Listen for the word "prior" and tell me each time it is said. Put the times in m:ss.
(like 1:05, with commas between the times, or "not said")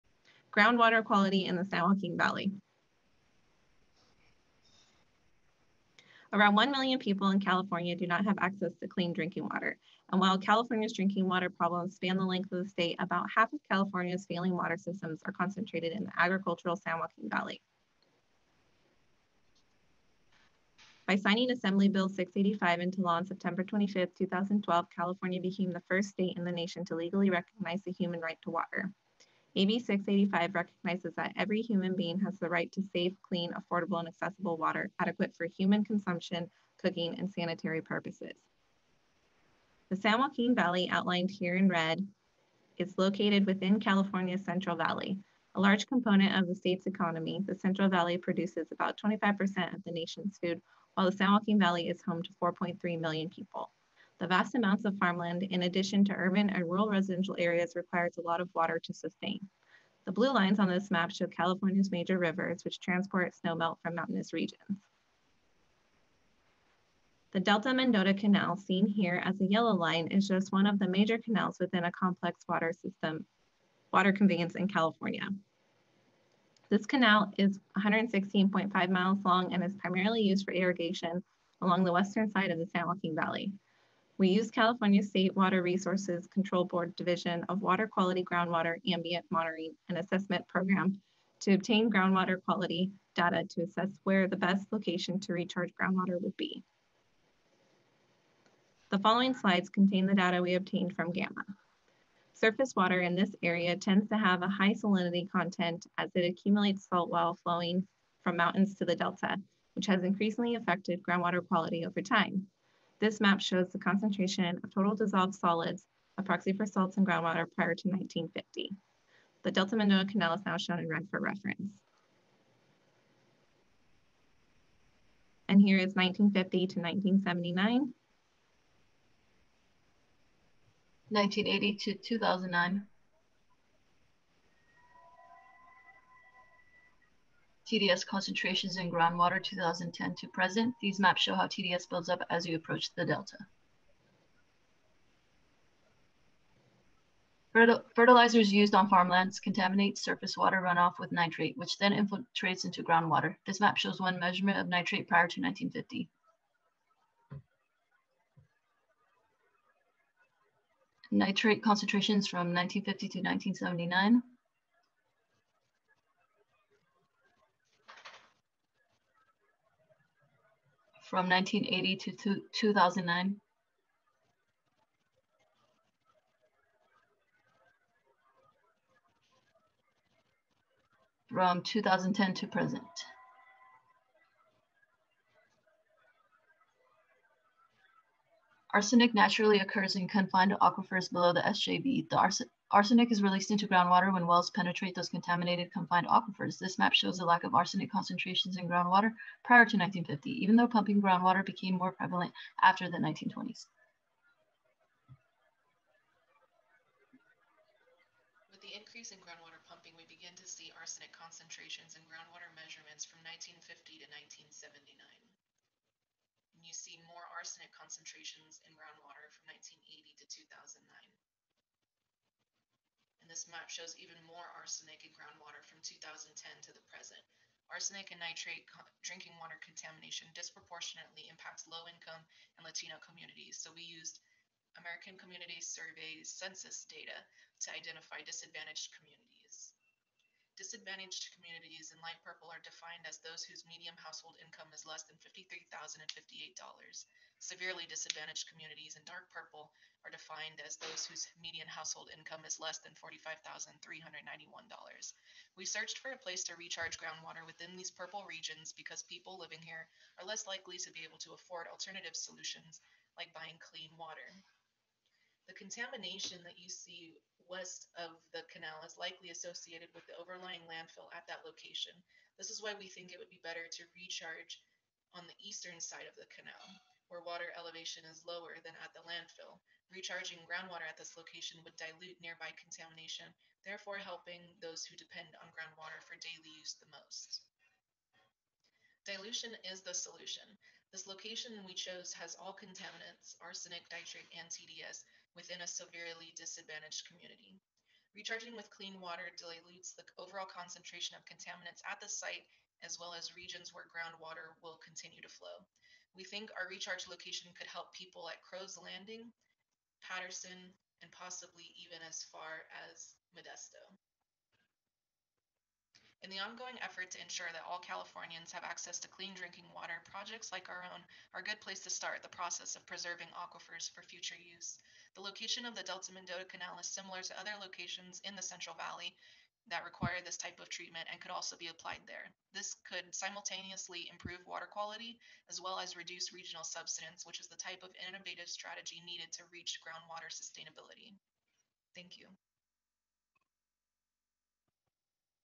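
1:57, 2:35, 3:19.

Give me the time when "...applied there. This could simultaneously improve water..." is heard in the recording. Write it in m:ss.
5:31.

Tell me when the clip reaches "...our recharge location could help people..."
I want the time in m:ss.
5:06.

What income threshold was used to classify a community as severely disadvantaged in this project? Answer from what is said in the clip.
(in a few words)
$45,391.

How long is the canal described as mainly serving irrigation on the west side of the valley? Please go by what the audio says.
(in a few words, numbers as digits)
116.5 miles.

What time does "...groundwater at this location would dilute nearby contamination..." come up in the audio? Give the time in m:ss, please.
4:40.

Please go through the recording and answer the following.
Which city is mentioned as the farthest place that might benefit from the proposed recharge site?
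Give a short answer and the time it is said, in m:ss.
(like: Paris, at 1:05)
Modesto, at 5:13.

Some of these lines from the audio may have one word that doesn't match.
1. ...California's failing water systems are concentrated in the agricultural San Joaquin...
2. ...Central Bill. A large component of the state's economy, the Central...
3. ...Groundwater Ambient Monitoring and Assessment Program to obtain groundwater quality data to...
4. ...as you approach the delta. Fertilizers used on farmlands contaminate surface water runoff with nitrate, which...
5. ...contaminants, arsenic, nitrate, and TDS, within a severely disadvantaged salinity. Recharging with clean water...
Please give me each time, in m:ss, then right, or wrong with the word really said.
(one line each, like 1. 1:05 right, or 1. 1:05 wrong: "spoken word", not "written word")
1. 0:13 right
2. 0:44 wrong: "Valley", not "Bill"
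3. 1:28 right
4. 2:22 right
5. 4:52 wrong: "community", not "salinity".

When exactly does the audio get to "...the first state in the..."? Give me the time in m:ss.
0:25.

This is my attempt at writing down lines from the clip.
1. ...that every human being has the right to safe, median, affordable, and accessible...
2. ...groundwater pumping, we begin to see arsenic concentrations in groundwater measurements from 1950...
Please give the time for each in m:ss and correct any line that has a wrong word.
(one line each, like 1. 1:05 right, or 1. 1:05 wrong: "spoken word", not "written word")
1. 0:31 wrong: "clean", not "median"
2. 3:29 right.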